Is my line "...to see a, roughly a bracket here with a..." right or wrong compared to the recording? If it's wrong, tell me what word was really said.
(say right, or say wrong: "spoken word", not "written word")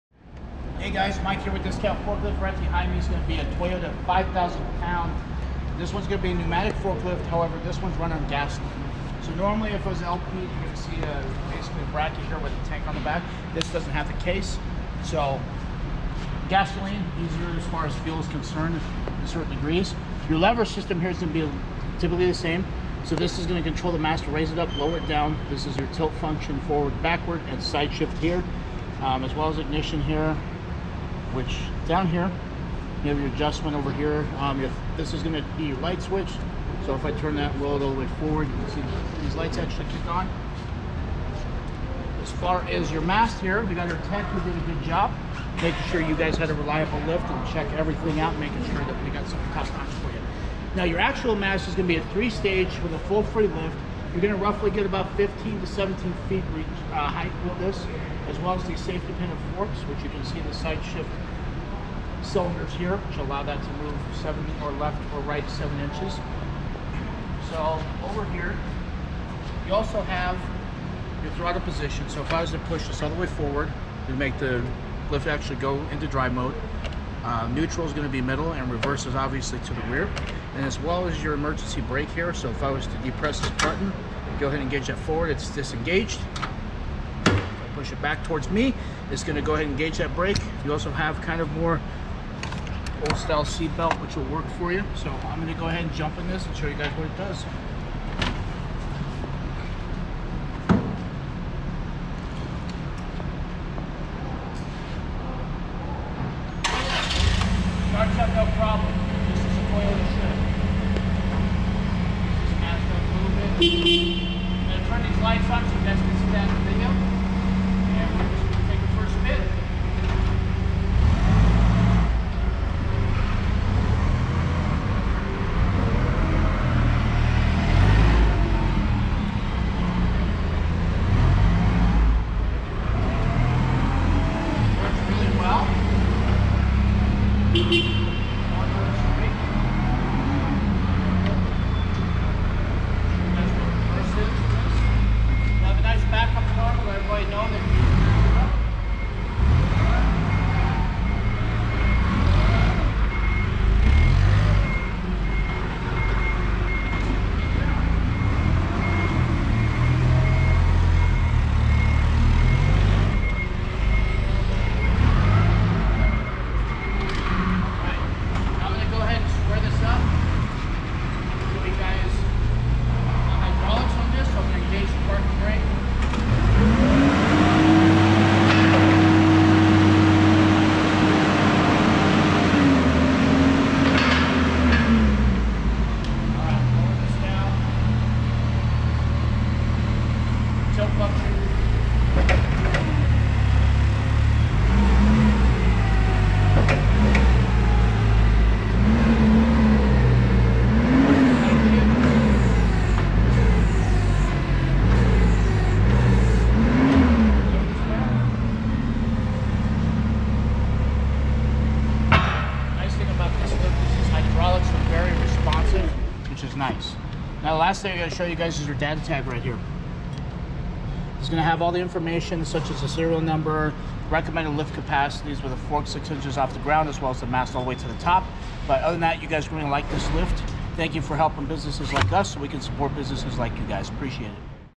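wrong: "basically", not "roughly".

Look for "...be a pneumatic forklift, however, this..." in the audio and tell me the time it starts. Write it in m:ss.
0:06.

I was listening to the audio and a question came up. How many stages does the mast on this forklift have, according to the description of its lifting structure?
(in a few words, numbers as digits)
3.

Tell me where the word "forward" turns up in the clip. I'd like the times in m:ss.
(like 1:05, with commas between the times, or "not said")
0:26, 0:38, 1:13, 1:24.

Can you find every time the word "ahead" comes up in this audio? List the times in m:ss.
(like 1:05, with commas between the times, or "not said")
1:24, 1:29, 1:35.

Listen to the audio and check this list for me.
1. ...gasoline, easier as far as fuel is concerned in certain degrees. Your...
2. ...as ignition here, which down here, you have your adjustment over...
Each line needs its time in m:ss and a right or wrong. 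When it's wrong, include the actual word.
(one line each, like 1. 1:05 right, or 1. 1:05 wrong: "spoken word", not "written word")
1. 0:16 right
2. 0:29 right.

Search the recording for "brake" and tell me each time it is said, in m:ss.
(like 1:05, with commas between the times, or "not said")
1:21, 1:30.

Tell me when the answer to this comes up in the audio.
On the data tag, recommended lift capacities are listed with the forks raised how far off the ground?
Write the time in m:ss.
3:45.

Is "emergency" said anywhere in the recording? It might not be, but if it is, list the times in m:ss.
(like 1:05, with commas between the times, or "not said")
1:21.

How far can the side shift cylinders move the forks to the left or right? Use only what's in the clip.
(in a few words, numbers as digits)
7 inches.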